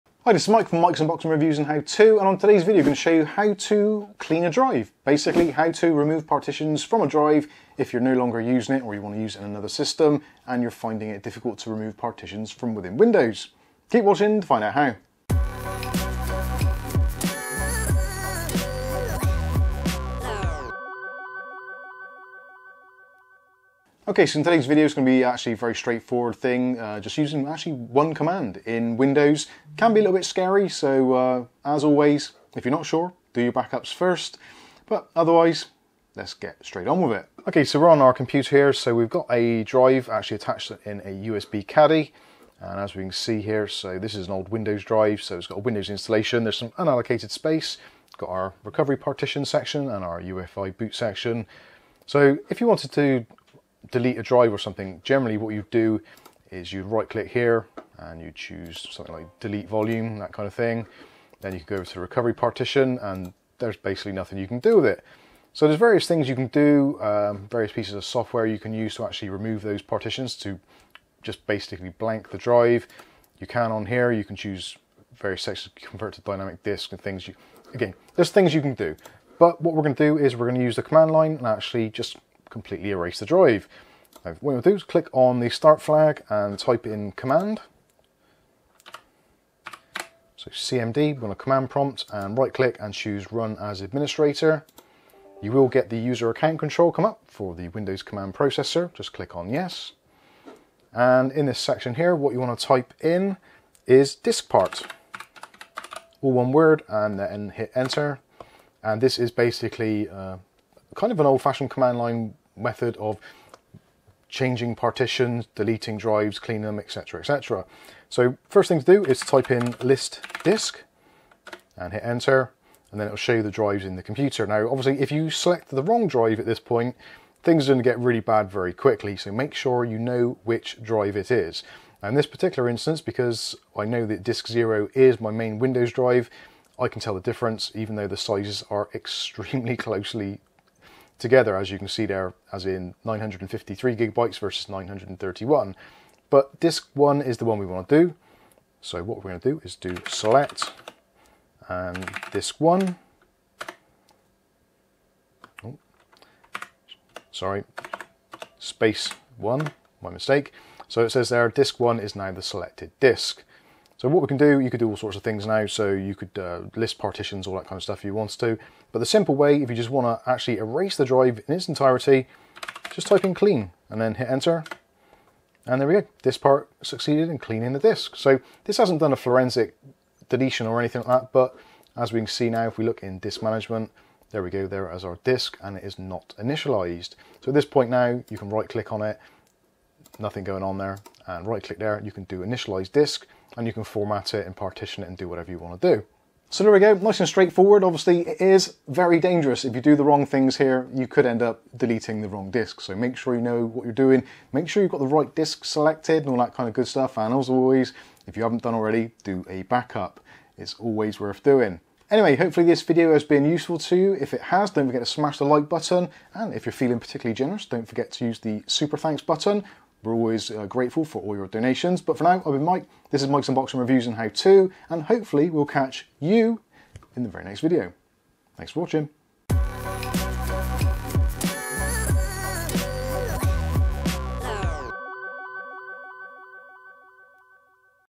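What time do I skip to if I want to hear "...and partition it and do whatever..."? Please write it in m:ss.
3:14.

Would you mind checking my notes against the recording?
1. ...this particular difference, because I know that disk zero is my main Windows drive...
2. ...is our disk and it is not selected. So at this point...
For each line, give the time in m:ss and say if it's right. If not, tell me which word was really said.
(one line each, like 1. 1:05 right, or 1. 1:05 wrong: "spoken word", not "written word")
1. 2:12 wrong: "instance", not "difference"
2. 3:04 wrong: "initialized", not "selected".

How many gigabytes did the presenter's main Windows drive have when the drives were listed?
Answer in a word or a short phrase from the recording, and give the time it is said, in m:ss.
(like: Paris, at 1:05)
953 gigabytes, at 2:23.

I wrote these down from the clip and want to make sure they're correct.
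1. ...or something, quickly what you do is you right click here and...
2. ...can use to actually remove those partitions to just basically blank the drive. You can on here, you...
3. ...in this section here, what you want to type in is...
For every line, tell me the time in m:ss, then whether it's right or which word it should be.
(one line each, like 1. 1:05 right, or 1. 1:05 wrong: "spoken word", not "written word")
1. 0:54 wrong: "generally", not "quickly"
2. 1:08 right
3. 1:41 right.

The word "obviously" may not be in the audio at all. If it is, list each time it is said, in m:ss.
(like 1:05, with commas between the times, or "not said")
2:04, 3:17.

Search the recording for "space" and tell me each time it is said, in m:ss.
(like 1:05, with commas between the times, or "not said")
0:47, 2:38.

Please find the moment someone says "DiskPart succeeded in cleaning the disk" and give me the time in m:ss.
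2:56.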